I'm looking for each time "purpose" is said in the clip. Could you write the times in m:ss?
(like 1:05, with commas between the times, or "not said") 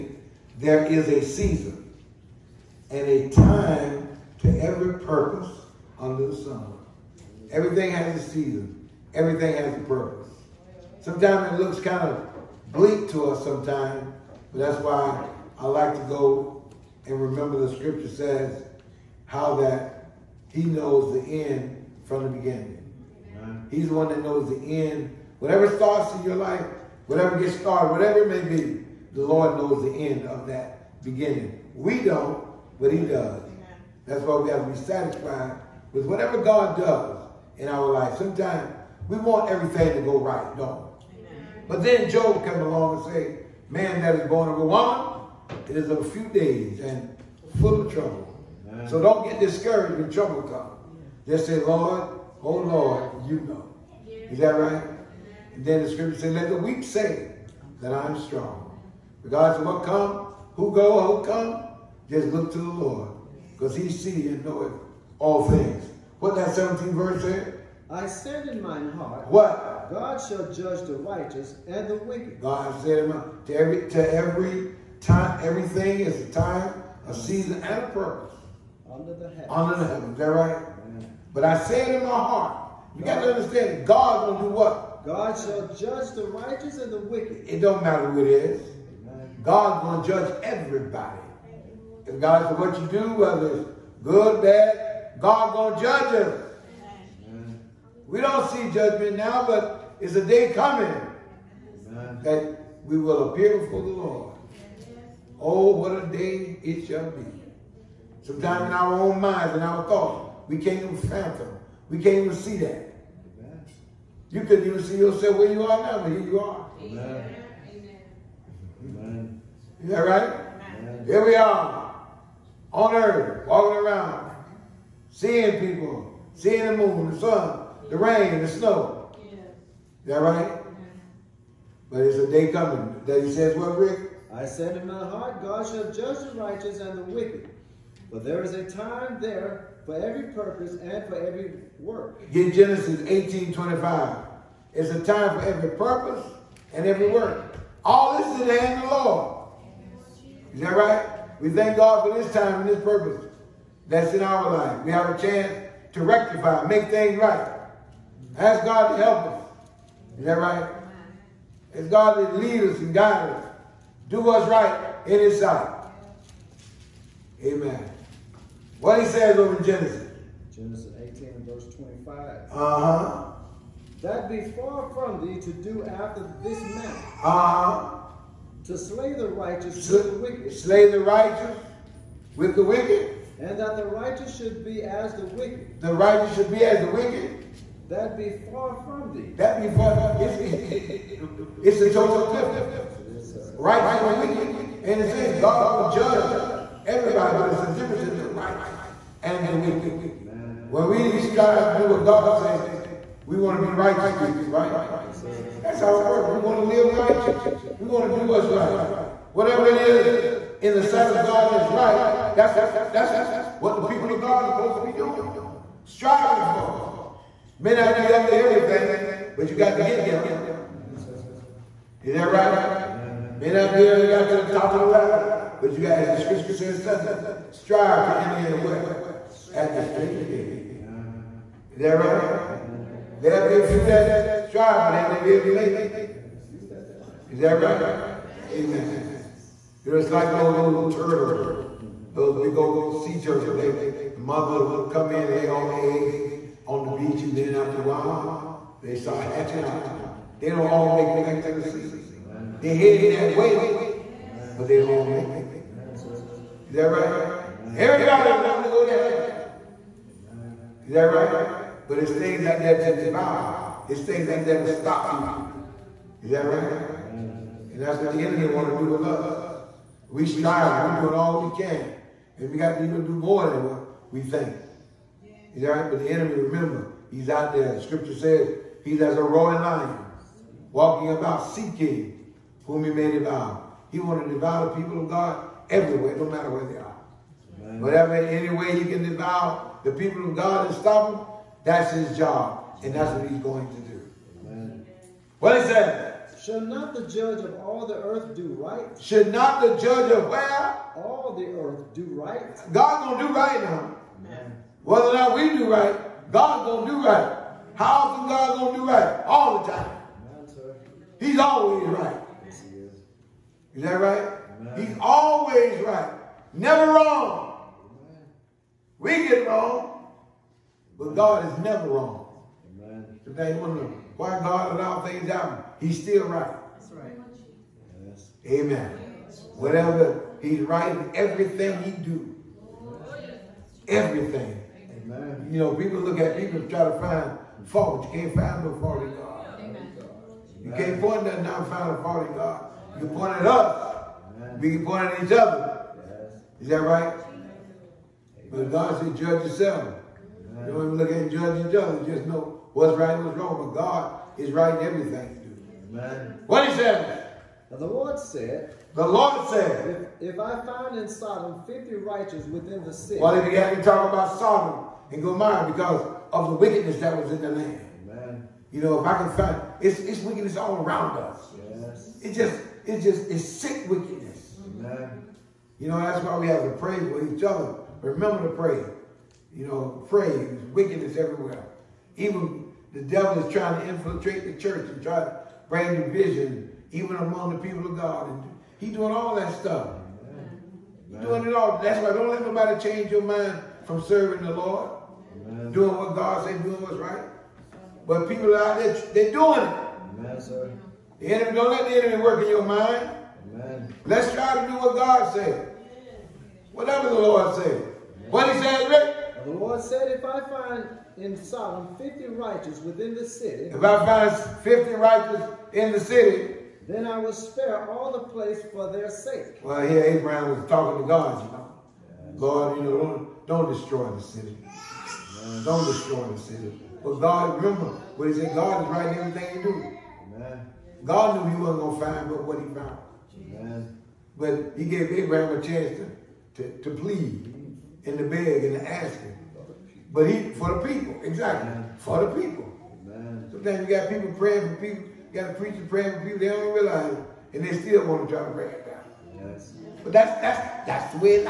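0:05, 0:09, 1:17, 2:20, 2:25, 2:32, 3:26.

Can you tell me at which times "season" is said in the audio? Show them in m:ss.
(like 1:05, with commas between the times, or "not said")
0:01, 0:08, 1:17.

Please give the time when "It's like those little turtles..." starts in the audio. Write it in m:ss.
3:59.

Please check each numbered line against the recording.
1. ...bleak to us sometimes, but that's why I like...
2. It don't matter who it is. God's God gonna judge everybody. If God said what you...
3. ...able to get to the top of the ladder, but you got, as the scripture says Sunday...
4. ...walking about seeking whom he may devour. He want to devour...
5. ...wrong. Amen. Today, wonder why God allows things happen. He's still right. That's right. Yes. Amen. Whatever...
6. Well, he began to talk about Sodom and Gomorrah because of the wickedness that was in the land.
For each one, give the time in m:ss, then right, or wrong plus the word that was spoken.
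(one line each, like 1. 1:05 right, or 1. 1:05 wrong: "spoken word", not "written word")
1. 0:12 right
2. 1:27 right
3. 3:43 right
4. 4:40 right
5. 5:21 right
6. 6:03 right.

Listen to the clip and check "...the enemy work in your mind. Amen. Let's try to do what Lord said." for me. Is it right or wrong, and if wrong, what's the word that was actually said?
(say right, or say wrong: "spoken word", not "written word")
wrong: "God", not "Lord".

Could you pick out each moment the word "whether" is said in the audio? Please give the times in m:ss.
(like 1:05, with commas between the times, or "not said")
1:33, 5:04.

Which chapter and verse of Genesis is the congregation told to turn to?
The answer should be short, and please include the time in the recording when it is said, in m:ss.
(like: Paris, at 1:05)
18:25, at 2:22.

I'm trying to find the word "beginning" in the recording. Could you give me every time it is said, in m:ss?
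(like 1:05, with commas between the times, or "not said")
0:22, 0:31.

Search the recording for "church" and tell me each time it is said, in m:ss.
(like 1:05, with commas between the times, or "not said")
6:24.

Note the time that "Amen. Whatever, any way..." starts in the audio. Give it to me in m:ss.
4:47.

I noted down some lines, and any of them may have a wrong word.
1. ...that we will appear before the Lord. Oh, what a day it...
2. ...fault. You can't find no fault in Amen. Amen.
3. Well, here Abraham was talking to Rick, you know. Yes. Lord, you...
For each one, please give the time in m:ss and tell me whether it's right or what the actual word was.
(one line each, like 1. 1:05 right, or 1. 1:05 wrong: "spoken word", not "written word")
1. 1:42 right
2. 5:37 wrong: "God", not "Amen"
3. 6:59 wrong: "God", not "Rick".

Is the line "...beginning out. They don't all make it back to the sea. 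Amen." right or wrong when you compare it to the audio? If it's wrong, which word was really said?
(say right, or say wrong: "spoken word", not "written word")
wrong: "hatching", not "beginning".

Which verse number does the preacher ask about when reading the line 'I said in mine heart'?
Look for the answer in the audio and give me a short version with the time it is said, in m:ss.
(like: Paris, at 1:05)
17, at 1:06.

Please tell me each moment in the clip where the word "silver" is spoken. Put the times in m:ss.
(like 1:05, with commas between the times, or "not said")
not said.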